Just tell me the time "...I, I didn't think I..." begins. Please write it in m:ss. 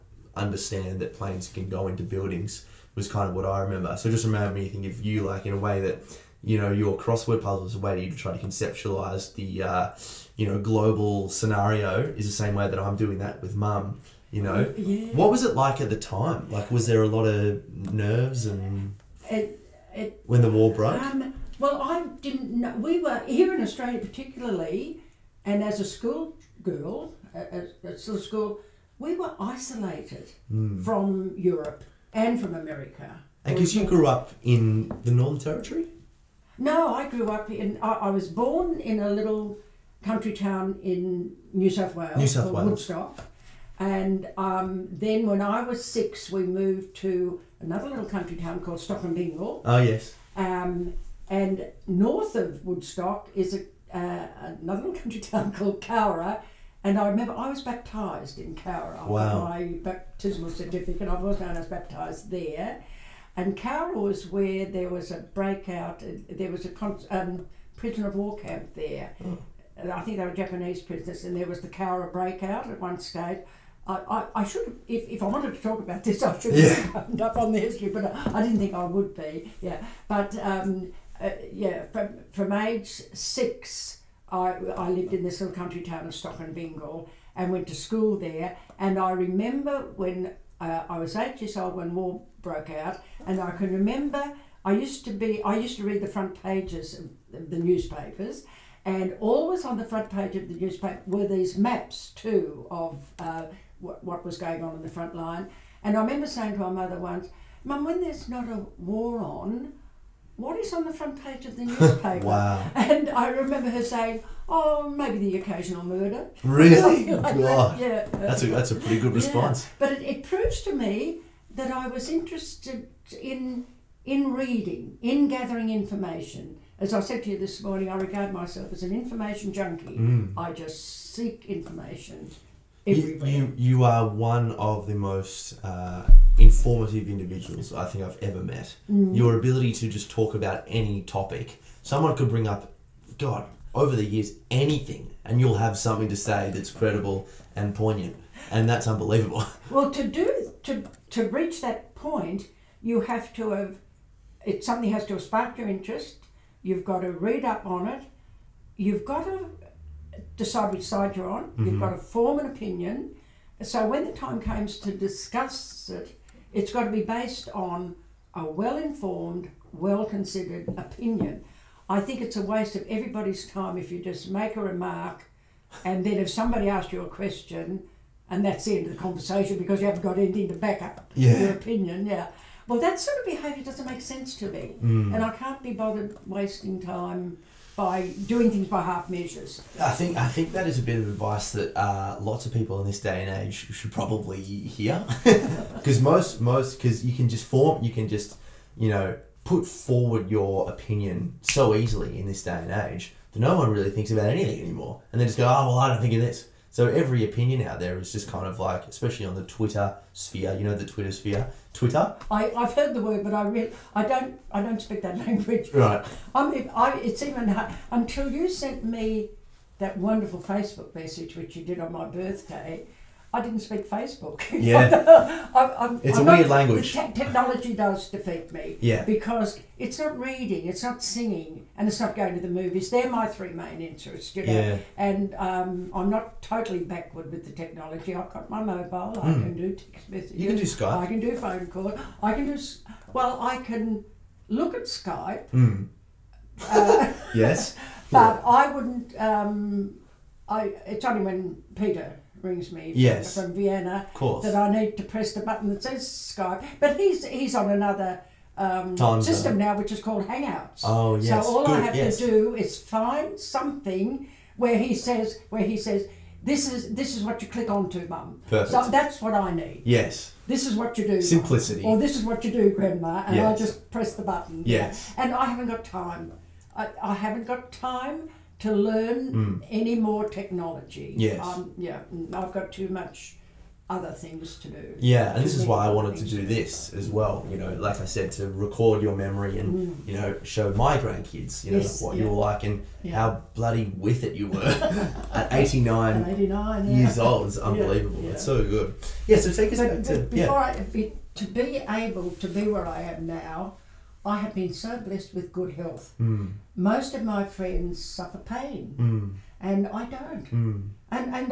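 1:18.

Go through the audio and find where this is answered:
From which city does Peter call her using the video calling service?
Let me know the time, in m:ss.
4:13.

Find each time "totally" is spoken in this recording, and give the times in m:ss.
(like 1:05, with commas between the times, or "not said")
3:56.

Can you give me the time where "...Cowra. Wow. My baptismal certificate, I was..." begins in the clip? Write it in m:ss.
0:58.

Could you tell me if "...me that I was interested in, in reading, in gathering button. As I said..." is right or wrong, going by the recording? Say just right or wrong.
wrong.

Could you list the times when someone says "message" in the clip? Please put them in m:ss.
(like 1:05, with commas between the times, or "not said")
3:40, 4:00.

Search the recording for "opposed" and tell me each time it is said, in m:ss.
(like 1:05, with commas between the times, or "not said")
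not said.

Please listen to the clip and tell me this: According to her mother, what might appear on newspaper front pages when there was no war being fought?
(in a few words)
the occasional murder.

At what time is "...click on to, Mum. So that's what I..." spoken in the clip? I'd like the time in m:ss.
4:27.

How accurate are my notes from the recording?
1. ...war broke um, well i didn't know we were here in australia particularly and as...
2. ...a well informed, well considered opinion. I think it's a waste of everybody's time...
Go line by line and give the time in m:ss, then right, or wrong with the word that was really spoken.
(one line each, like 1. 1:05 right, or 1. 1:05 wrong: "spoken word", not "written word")
1. 0:20 right
2. 2:48 right.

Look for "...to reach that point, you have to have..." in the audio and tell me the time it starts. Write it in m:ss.
2:31.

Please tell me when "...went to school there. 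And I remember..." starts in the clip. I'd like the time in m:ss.
1:27.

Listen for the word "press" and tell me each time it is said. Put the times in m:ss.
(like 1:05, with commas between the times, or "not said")
4:15, 4:33.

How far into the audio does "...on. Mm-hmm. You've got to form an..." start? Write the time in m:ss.
2:41.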